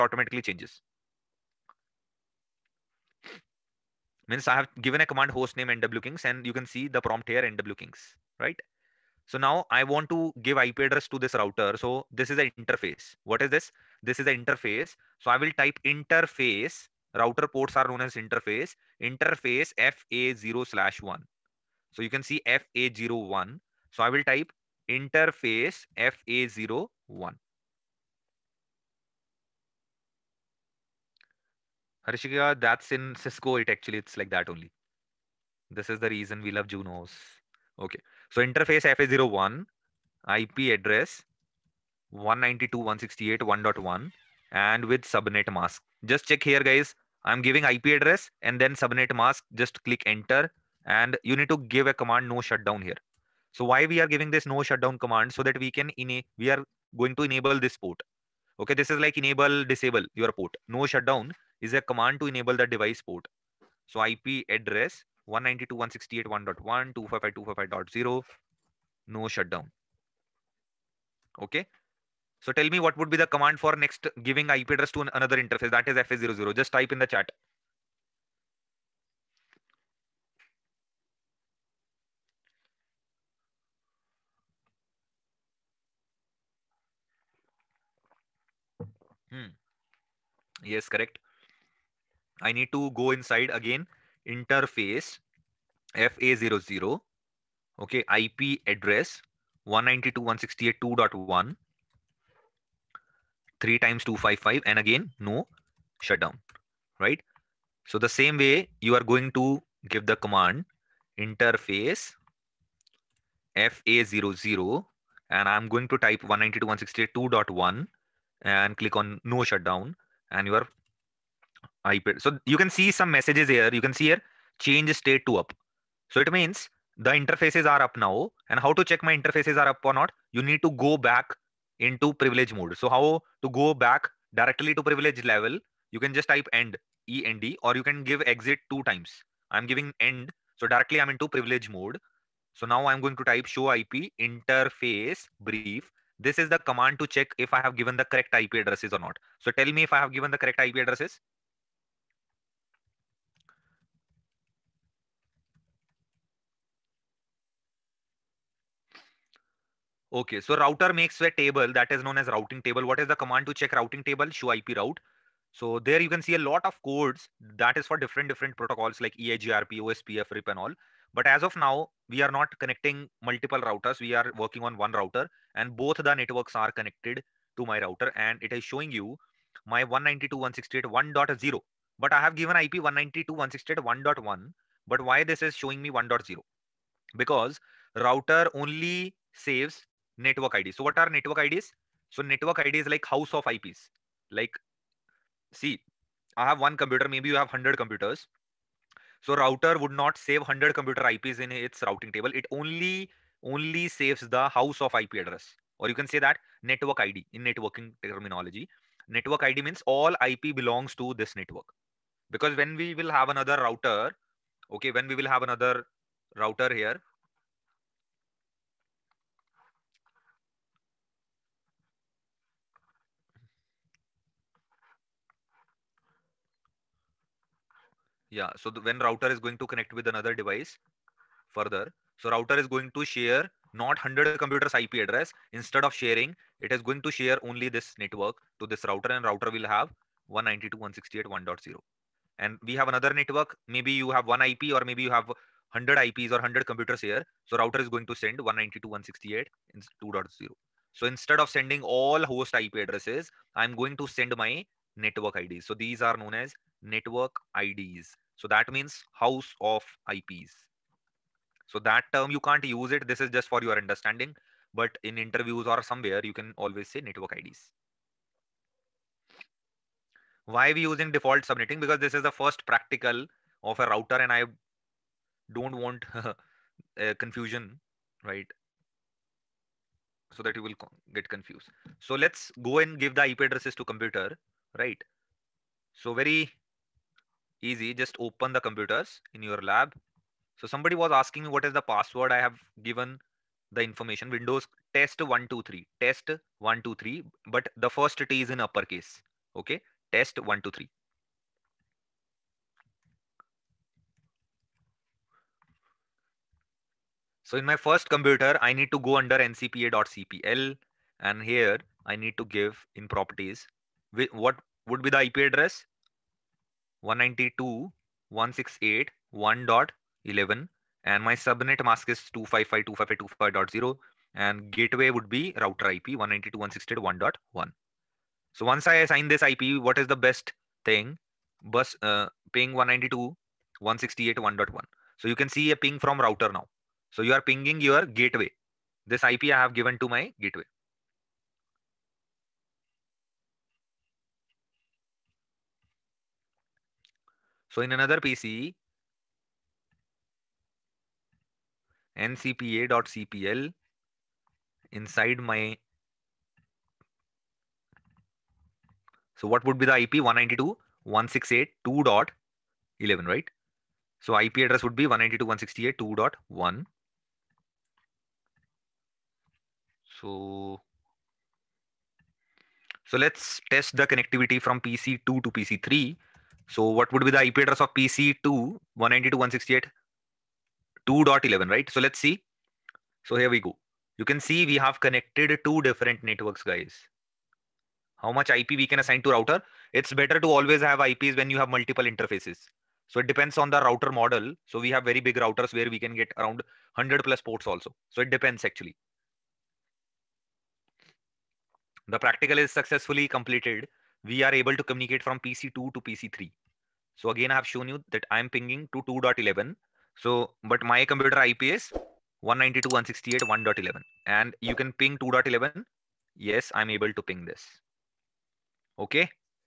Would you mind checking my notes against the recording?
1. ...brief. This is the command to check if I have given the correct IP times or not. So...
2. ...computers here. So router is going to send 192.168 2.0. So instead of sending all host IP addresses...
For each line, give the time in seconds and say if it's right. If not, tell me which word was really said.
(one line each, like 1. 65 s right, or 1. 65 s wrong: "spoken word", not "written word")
1. 145 s wrong: "addresses", not "times"
2. 246 s right.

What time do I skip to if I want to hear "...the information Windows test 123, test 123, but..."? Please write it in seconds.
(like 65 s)
293 s.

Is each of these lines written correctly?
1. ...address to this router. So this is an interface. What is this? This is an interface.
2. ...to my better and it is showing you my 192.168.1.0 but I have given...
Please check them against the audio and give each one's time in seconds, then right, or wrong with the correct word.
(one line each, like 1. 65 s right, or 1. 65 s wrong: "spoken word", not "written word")
1. 10 s right
2. 177 s wrong: "router", not "better".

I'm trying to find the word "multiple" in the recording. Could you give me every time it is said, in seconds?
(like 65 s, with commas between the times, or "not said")
173 s, 391 s.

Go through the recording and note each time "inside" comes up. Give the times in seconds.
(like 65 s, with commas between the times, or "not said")
93 s, 354 s.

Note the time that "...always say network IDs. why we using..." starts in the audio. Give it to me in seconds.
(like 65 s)
266 s.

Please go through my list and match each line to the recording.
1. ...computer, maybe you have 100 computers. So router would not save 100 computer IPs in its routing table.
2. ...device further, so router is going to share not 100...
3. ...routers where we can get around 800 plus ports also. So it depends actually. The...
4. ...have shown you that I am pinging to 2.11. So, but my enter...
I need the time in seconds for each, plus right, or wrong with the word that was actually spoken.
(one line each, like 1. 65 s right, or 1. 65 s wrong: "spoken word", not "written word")
1. 196 s right
2. 230 s right
3. 395 s wrong: "100", not "800"
4. 407 s wrong: "computer", not "enter".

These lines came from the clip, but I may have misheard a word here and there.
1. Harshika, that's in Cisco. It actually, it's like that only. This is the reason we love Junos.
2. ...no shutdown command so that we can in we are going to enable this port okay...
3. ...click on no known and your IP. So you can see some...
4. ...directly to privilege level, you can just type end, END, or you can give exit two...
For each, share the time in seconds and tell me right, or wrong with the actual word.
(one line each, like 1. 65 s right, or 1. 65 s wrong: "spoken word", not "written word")
1. 32 s right
2. 54 s right
3. 118 s wrong: "shutdown", not "known"
4. 134 s right.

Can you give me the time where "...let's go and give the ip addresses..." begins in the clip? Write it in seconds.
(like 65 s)
282 s.